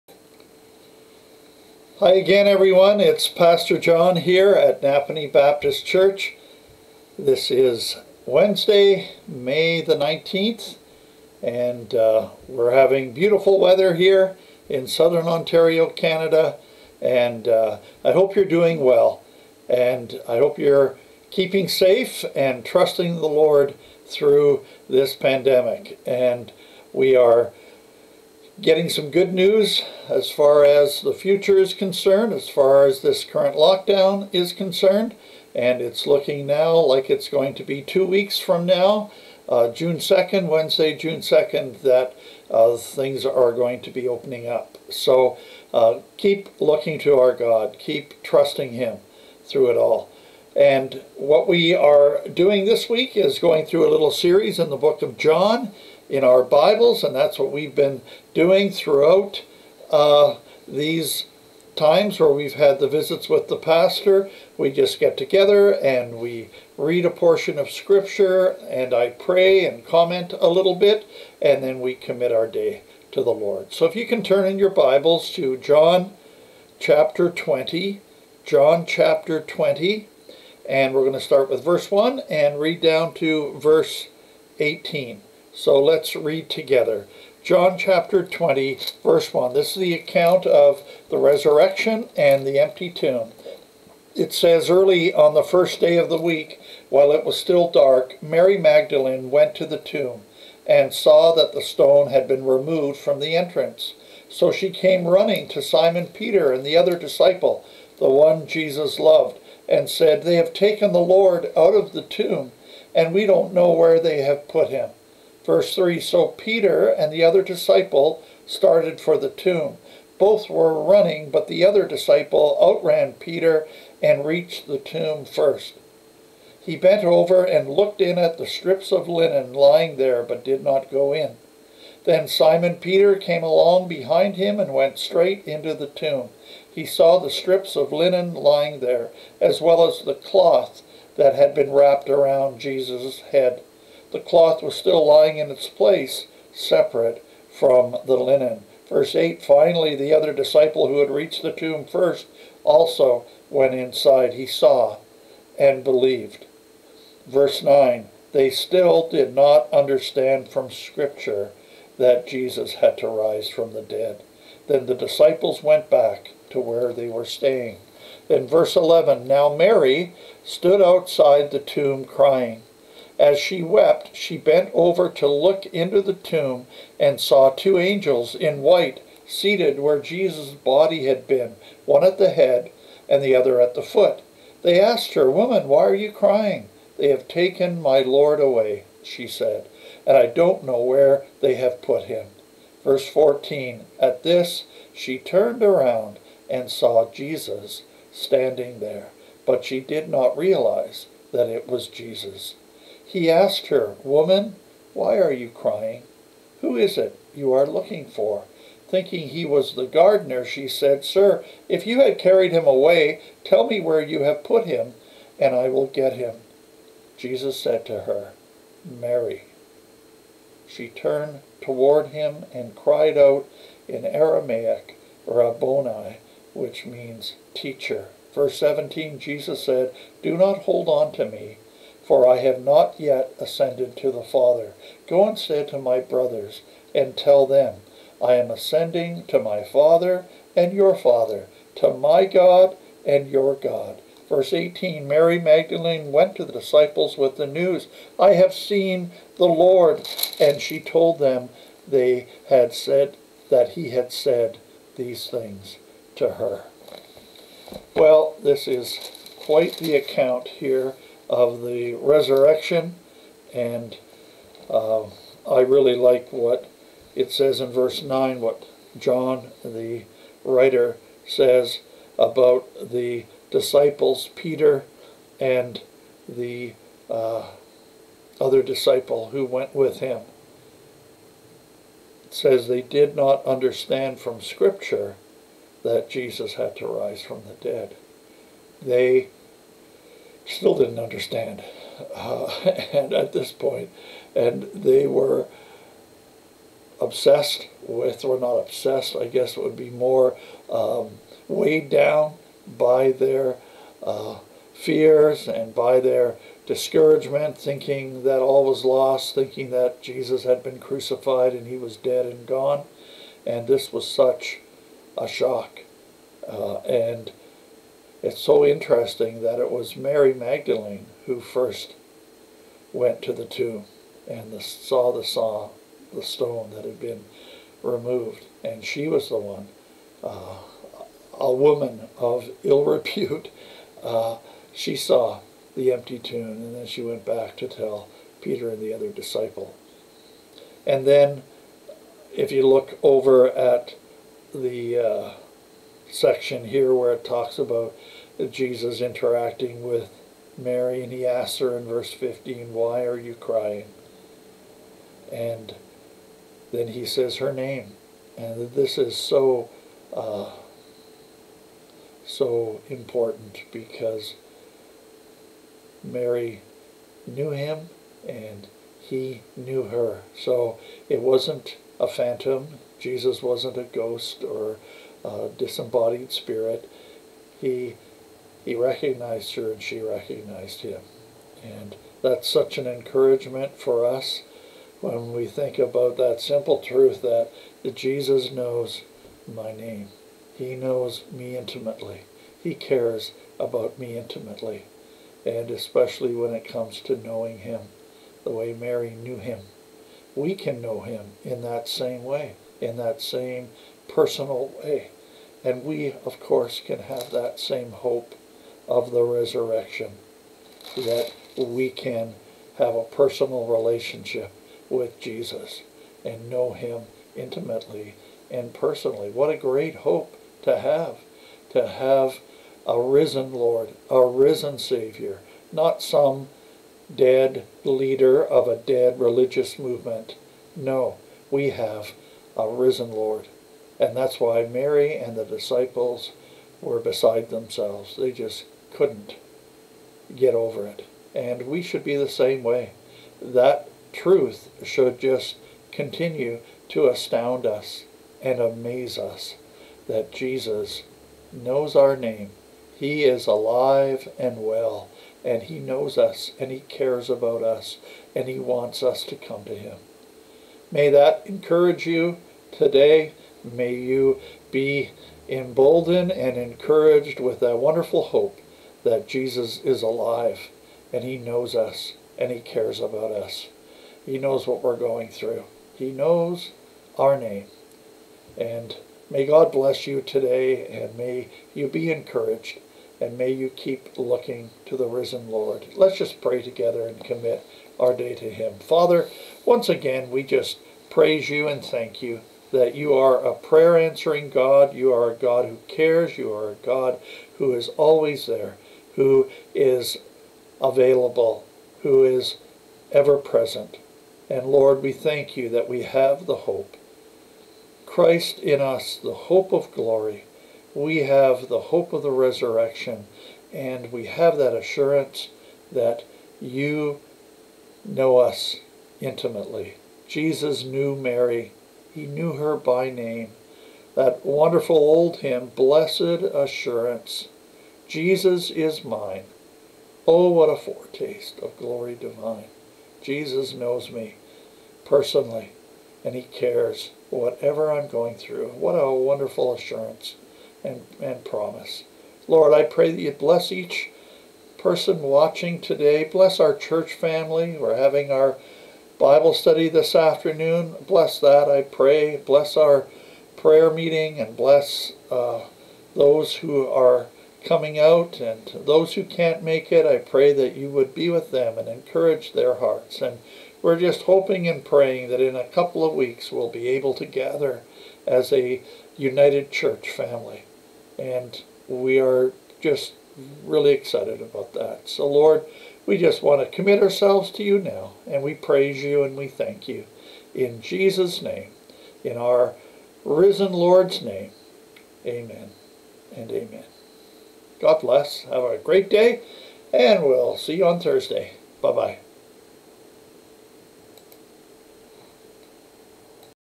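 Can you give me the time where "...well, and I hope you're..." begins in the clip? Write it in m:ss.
0:18.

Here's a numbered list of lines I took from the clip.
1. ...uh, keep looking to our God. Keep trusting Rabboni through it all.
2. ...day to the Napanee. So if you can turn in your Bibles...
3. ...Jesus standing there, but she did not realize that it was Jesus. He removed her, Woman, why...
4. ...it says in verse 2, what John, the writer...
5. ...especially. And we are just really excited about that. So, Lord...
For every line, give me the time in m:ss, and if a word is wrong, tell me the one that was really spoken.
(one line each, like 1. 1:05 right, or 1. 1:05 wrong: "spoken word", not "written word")
1. 0:45 wrong: "Him", not "Rabboni"
2. 1:12 wrong: "Lord", not "Napanee"
3. 3:17 wrong: "asked", not "removed"
4. 4:27 wrong: "9", not "2"
5. 9:30 wrong: "family", not "especially".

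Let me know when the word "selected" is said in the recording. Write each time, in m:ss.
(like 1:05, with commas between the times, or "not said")
not said.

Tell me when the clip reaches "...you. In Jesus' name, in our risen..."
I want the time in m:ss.
9:39.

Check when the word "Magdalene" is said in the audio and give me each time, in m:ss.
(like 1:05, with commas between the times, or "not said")
1:38, 4:05, 5:20.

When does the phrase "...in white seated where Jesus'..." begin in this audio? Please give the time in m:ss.
2:58.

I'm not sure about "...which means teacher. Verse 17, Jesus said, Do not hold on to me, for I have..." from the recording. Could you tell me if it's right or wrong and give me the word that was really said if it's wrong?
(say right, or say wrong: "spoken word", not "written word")
right.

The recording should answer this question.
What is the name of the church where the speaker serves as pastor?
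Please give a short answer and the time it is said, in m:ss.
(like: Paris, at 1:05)
Napanee Baptist Church, at 0:04.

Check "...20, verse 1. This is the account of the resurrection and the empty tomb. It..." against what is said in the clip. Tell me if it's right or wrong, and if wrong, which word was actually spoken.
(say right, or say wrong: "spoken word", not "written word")
right.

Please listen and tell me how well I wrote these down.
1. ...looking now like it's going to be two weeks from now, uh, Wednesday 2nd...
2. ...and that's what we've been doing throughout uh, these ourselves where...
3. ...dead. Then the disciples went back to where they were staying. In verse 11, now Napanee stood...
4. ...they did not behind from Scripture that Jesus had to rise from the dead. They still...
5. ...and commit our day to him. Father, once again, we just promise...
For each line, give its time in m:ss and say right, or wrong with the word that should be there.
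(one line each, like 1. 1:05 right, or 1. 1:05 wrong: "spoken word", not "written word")
1. 0:36 wrong: "June", not "Wednesday"
2. 0:57 wrong: "times", not "ourselves"
3. 2:43 wrong: "Mary", not "Napanee"
4. 4:42 wrong: "understand", not "behind"
5. 8:07 wrong: "praise", not "promise".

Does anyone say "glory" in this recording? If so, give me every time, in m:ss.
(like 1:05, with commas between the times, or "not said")
8:29, 8:51.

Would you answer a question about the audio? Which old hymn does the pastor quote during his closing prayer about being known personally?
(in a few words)
Blessed Assurance.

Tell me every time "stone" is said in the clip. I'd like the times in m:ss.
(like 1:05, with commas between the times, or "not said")
1:41, 5:26.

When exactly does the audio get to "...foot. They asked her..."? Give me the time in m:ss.
3:03.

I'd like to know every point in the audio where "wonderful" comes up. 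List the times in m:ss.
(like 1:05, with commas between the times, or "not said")
7:47, 8:44, 8:59.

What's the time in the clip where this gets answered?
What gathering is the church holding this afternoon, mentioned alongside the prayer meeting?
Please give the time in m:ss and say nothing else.
9:09.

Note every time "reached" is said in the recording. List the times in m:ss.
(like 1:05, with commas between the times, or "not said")
2:04, 2:31.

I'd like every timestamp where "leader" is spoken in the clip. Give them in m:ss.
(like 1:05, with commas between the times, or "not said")
7:07.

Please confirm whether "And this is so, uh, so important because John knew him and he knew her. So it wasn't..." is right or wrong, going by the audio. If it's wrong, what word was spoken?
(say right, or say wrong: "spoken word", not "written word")
wrong: "Mary", not "John".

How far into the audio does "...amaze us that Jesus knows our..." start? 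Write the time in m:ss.
7:28.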